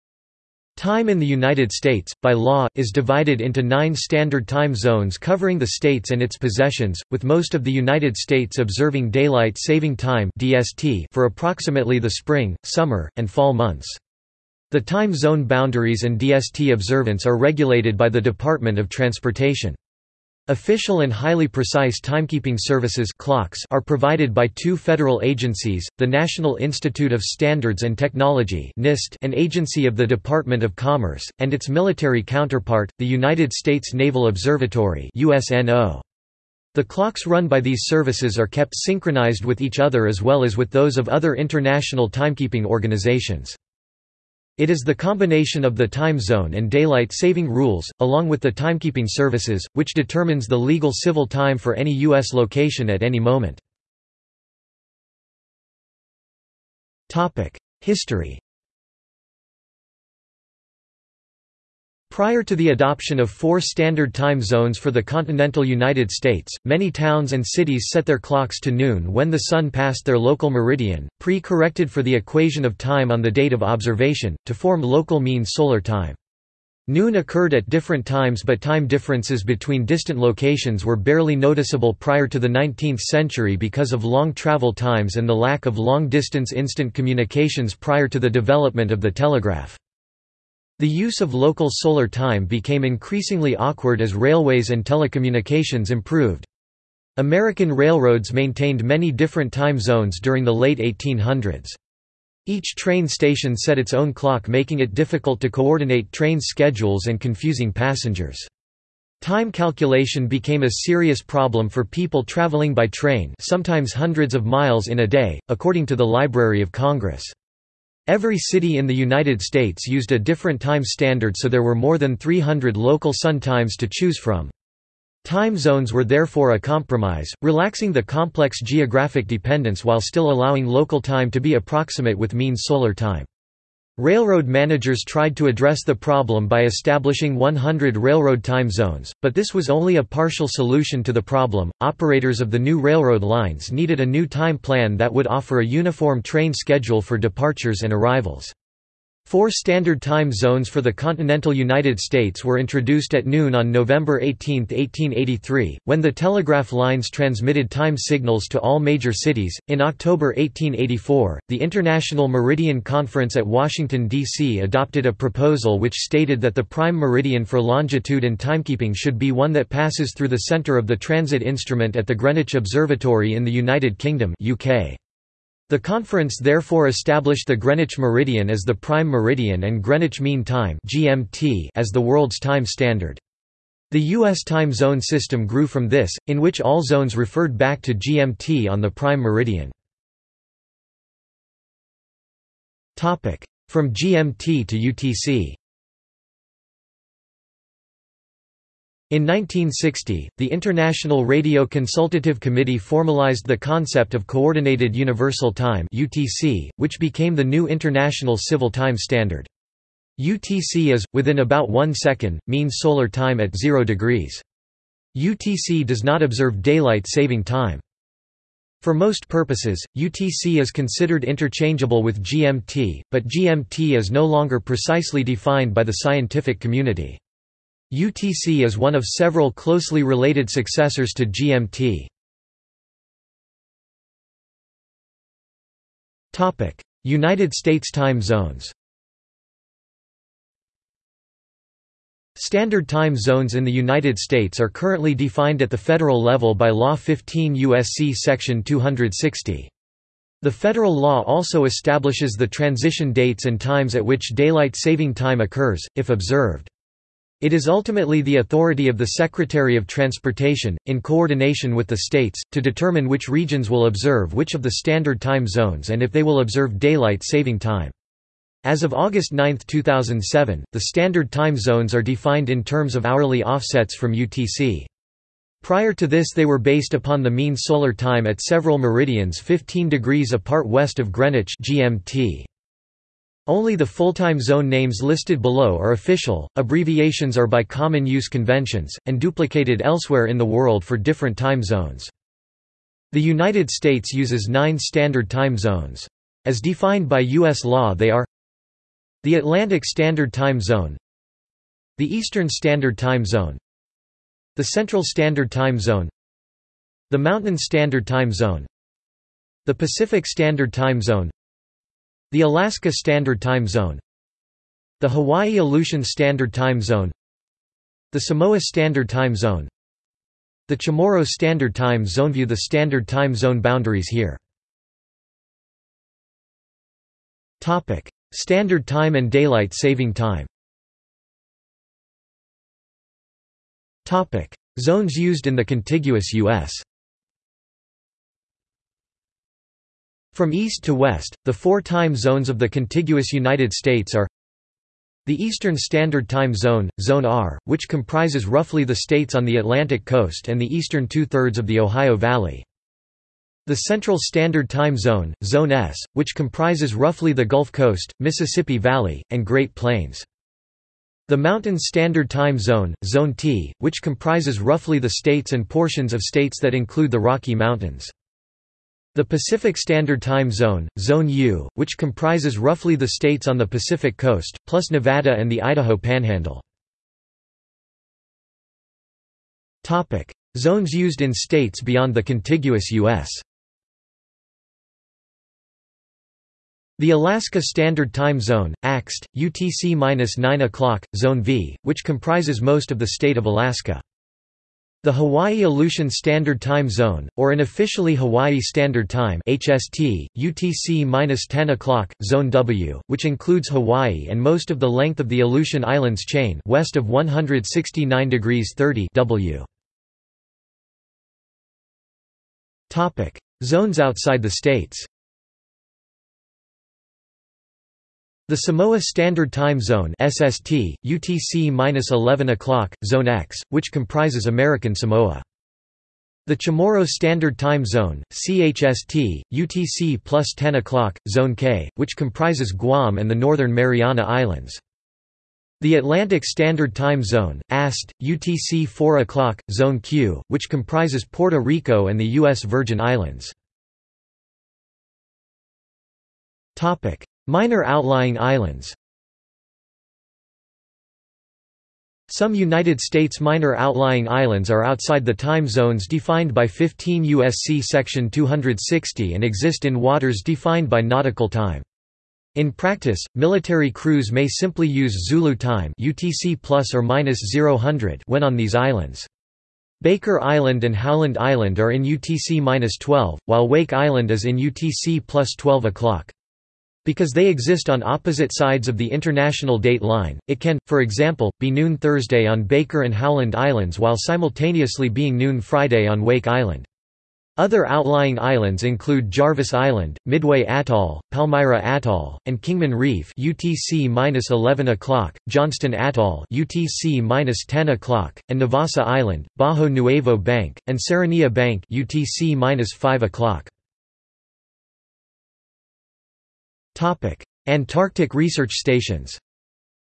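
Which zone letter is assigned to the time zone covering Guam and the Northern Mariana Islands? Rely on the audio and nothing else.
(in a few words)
Zone K.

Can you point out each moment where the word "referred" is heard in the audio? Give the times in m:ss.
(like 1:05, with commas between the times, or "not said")
3:07.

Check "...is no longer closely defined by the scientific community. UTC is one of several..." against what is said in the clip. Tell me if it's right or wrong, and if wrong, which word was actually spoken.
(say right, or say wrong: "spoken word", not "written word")
wrong: "precisely", not "closely".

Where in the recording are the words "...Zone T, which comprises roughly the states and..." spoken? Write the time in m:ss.
6:03.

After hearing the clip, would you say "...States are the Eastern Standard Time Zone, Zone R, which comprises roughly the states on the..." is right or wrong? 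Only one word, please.
right.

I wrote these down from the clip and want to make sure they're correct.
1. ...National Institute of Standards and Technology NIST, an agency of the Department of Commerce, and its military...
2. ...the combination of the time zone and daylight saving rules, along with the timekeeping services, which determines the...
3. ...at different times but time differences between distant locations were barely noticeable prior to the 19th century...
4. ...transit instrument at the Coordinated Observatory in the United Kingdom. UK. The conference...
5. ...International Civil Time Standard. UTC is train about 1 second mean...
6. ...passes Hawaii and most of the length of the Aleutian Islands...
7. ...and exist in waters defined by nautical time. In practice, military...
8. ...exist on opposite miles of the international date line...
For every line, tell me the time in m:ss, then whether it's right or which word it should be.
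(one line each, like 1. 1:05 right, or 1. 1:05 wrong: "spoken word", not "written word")
1. 0:26 right
2. 0:44 right
3. 1:17 right
4. 2:50 wrong: "Greenwich", not "Coordinated"
5. 3:27 wrong: "within", not "train"
6. 6:43 wrong: "includes", not "passes"
7. 7:39 right
8. 7:57 wrong: "sides", not "miles".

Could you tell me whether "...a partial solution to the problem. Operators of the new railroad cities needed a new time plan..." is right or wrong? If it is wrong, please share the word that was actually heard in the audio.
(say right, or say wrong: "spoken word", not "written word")
wrong: "lines", not "cities".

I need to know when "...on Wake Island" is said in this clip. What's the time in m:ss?
8:06.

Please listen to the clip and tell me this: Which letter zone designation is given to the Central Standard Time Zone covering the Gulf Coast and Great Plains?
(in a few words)
Zone S.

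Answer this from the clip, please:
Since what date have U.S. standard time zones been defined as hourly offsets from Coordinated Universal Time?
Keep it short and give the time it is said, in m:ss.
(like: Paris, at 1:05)
August 9, 2007, at 4:28.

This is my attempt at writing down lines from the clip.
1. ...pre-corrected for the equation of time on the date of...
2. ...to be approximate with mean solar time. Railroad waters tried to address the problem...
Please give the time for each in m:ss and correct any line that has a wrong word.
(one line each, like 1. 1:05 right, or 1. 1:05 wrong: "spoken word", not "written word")
1. 1:11 right
2. 2:11 wrong: "managers", not "waters".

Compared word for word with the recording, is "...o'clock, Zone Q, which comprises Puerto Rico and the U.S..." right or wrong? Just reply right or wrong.
right.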